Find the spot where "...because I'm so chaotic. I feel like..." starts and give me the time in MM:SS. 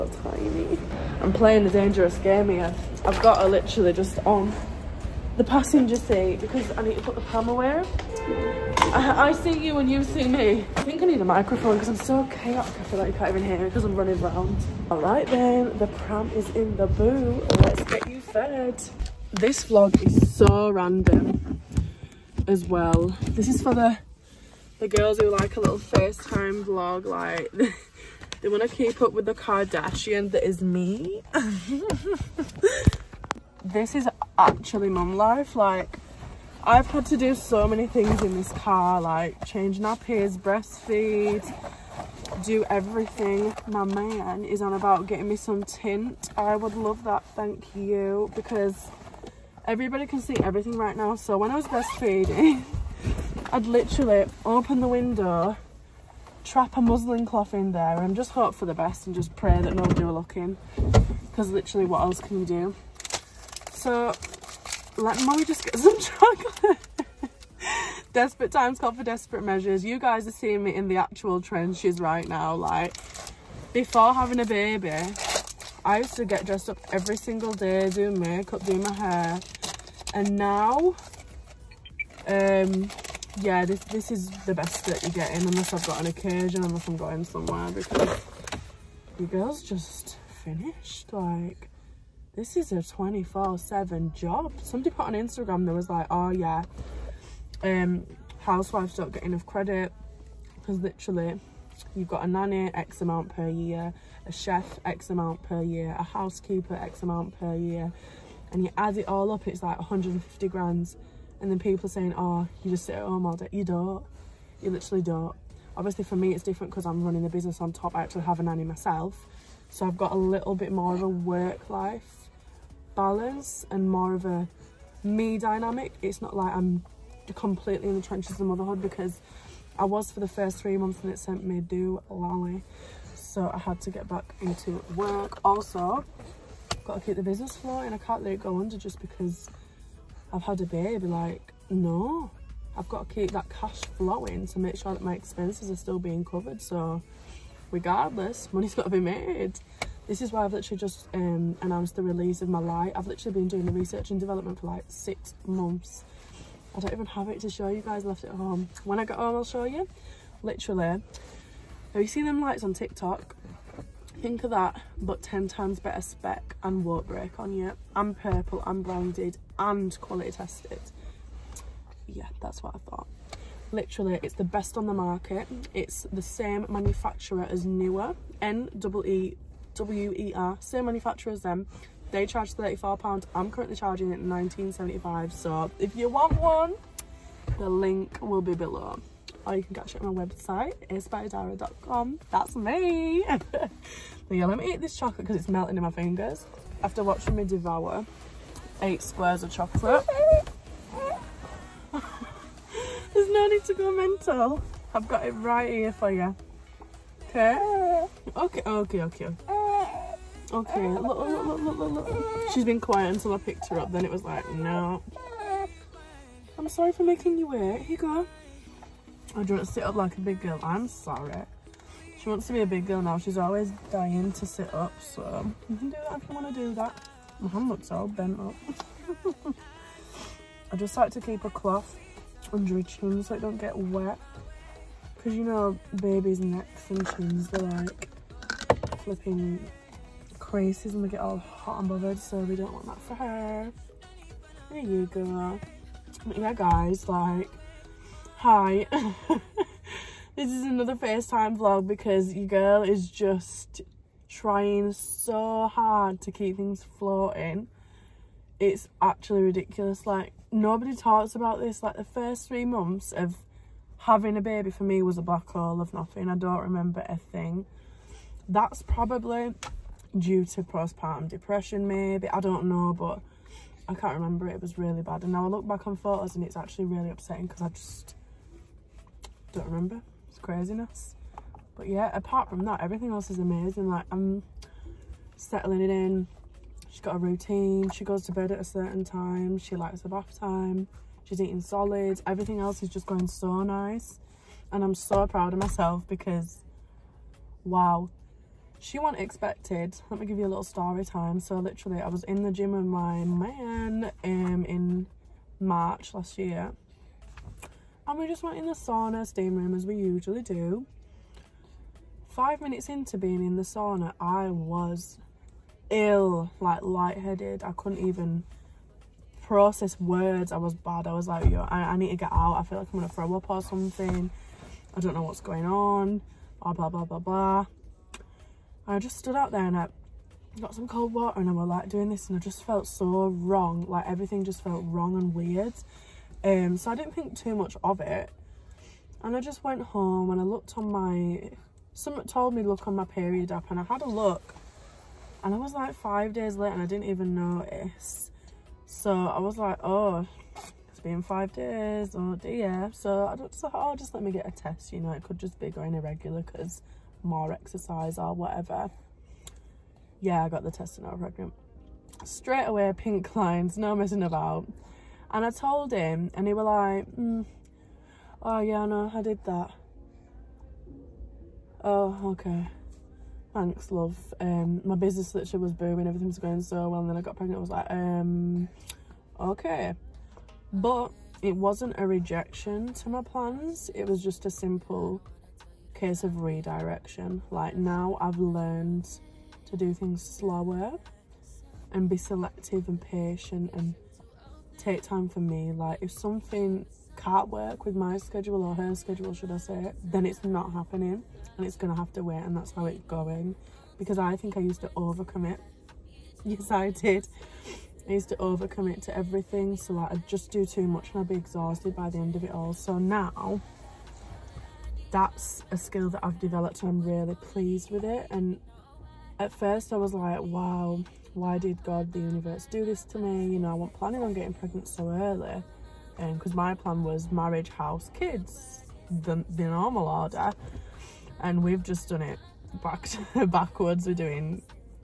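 00:11.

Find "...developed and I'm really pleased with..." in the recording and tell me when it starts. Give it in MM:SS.
06:56.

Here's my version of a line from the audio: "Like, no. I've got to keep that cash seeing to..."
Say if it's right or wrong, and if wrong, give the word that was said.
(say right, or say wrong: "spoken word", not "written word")
wrong: "flowing", not "seeing".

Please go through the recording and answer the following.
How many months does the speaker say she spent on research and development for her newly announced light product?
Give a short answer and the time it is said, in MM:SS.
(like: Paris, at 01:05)
6 months, at 02:34.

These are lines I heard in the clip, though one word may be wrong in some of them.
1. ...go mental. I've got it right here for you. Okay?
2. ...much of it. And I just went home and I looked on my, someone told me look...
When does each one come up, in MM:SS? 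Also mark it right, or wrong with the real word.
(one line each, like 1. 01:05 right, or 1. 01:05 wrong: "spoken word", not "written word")
1. 03:23 right
2. 05:37 right.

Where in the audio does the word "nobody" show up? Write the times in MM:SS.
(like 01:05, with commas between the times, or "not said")
00:59, 04:20.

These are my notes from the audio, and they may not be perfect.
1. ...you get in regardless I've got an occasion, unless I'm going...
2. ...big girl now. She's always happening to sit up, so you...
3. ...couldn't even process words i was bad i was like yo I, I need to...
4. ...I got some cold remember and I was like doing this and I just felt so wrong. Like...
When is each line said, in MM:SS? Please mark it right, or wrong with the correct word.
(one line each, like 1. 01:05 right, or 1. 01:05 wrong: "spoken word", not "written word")
1. 01:25 wrong: "unless", not "regardless"
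2. 03:42 wrong: "dying", not "happening"
3. 05:17 right
4. 05:29 wrong: "water", not "remember".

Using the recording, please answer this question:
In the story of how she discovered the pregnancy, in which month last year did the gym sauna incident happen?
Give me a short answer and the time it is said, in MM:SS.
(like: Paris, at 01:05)
March, at 05:05.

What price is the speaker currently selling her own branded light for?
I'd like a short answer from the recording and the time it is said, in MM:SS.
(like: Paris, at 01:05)
19.75, at 03:04.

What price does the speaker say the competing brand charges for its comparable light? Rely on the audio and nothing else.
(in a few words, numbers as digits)
£34.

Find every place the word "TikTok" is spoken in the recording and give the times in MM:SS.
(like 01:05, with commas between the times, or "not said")
02:42.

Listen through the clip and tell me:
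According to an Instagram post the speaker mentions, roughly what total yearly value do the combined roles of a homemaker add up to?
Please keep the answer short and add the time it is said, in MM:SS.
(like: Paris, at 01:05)
150 grand, at 01:49.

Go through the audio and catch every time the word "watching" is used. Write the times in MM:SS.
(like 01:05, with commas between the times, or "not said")
03:17.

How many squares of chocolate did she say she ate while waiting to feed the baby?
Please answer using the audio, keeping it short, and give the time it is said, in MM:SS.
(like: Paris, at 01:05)
8, at 03:18.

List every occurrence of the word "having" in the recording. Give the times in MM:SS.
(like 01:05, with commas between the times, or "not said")
01:14, 04:23.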